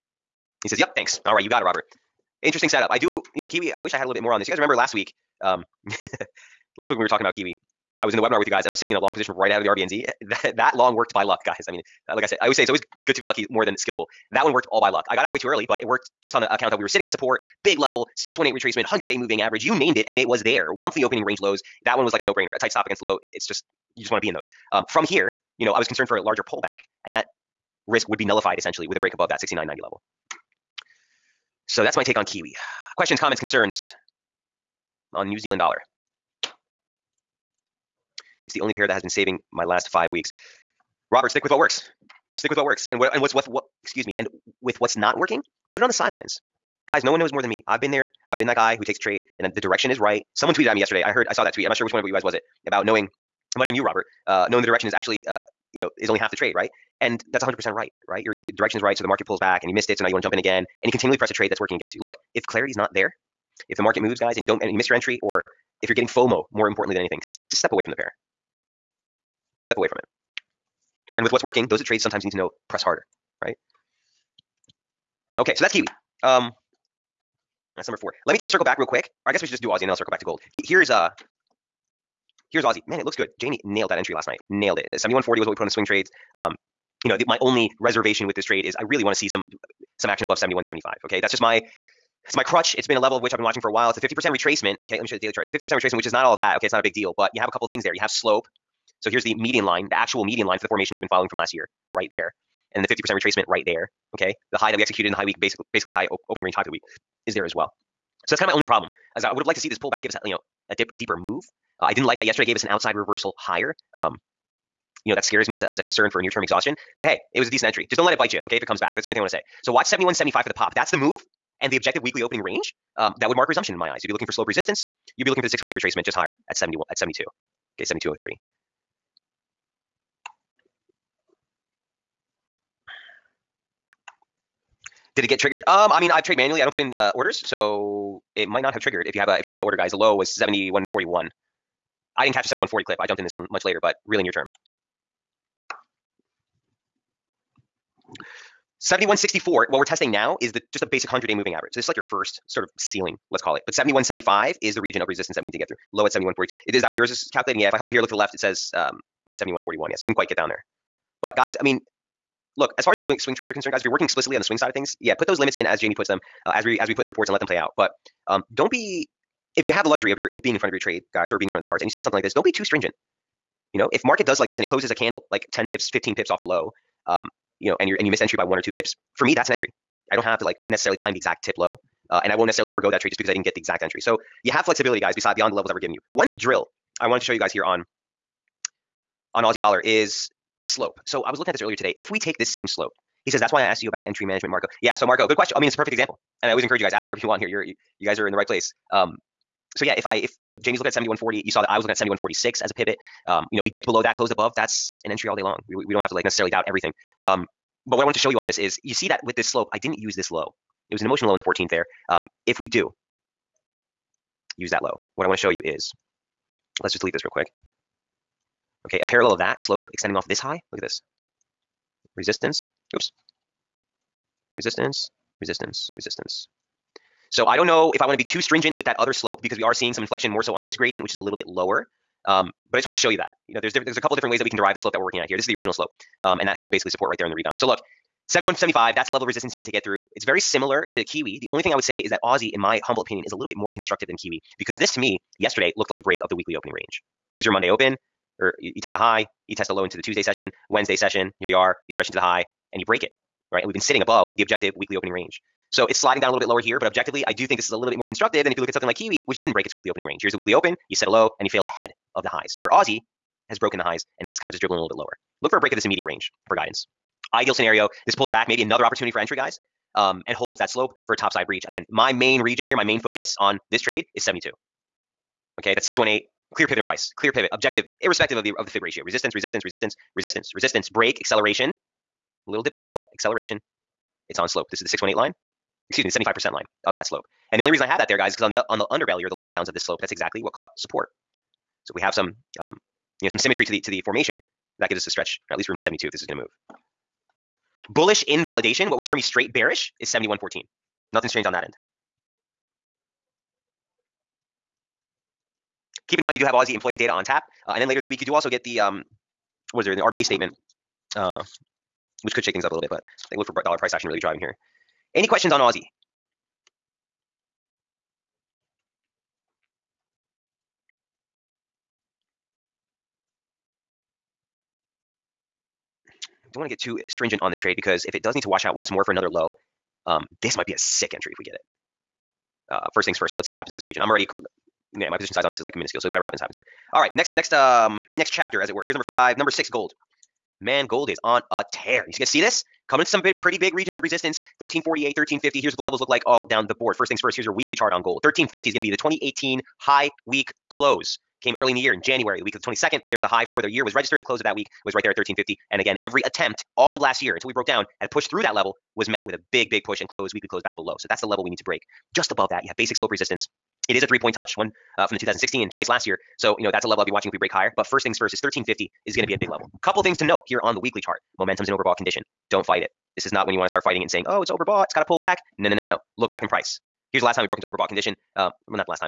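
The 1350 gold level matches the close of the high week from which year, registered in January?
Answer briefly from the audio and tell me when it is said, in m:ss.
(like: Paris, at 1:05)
2018, at 5:48.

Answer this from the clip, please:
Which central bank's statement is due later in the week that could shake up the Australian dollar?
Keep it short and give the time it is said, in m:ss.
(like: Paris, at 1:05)
RBA, at 5:09.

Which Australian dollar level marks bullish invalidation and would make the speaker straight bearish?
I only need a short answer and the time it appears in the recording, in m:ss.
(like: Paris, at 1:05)
71.14, at 5:00.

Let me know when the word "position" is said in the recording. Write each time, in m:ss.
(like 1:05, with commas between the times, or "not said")
0:09, 5:35.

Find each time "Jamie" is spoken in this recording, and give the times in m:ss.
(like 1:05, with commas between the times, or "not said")
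1:23, 2:45, 3:20.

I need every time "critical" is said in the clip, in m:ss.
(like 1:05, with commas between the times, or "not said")
not said.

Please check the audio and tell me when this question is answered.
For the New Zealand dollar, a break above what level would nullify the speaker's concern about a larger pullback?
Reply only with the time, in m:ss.
0:29.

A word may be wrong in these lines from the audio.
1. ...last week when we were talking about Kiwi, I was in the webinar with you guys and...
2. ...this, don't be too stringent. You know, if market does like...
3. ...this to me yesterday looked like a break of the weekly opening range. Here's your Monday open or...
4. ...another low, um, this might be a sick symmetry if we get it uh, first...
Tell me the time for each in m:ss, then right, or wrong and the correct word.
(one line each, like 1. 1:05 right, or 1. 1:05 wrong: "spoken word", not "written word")
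1. 0:06 right
2. 2:52 right
3. 4:04 right
4. 5:29 wrong: "entry", not "symmetry".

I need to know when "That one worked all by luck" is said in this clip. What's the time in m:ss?
0:14.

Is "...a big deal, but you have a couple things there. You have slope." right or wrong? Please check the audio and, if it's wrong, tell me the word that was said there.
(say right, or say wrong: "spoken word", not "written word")
right.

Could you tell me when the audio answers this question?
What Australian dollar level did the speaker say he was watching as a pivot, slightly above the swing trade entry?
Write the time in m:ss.
3:21.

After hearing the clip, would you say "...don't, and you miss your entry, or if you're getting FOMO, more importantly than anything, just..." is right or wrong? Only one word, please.
right.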